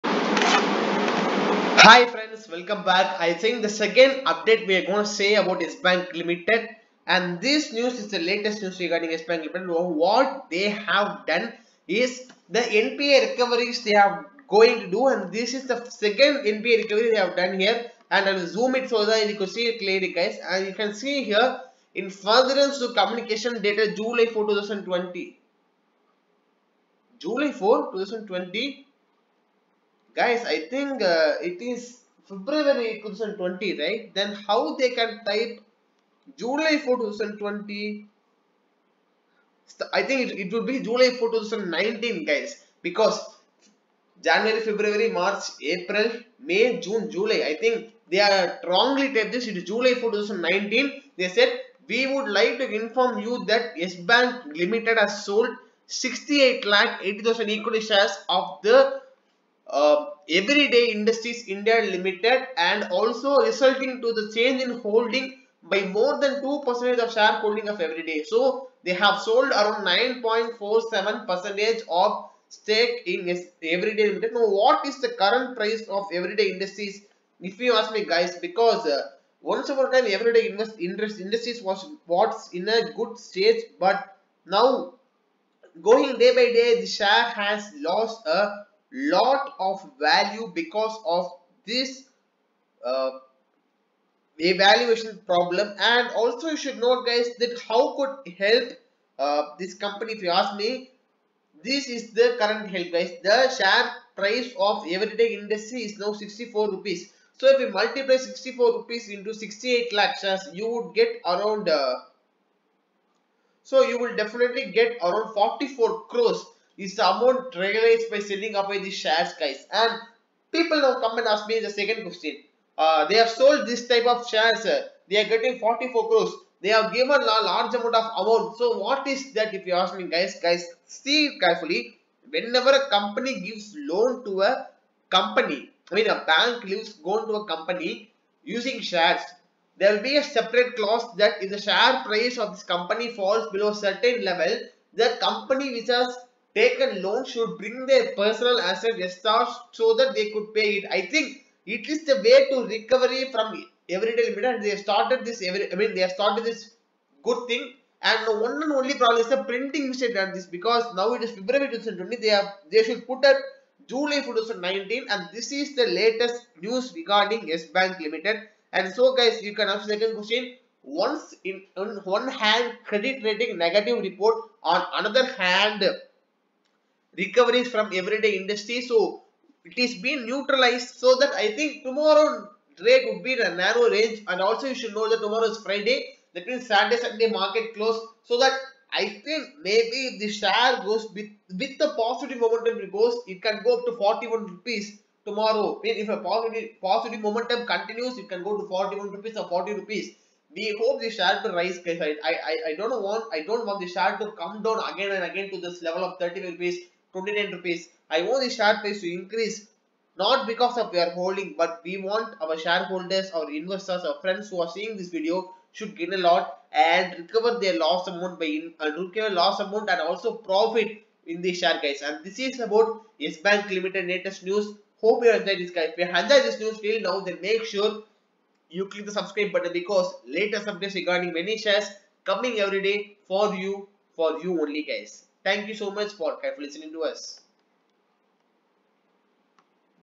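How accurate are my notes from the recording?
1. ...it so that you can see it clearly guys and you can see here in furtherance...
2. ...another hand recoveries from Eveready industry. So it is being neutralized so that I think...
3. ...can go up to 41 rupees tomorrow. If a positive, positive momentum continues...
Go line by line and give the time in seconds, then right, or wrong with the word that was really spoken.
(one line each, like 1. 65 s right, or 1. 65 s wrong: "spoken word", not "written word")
1. 18 s right
2. 174 s right
3. 193 s right.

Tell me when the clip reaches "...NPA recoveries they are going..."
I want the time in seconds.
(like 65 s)
12 s.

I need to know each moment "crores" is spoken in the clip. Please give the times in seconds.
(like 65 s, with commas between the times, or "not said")
116 s, 126 s.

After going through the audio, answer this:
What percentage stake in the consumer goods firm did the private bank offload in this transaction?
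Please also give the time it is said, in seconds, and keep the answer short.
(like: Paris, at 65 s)
9.47%, at 69 s.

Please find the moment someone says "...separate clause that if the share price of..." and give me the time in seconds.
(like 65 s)
140 s.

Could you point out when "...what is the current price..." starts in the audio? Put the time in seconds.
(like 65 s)
74 s.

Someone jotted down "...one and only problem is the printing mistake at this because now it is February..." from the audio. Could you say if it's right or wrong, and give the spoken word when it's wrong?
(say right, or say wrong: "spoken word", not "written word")
right.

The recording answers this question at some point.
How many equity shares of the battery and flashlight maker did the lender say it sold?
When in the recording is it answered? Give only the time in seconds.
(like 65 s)
55 s.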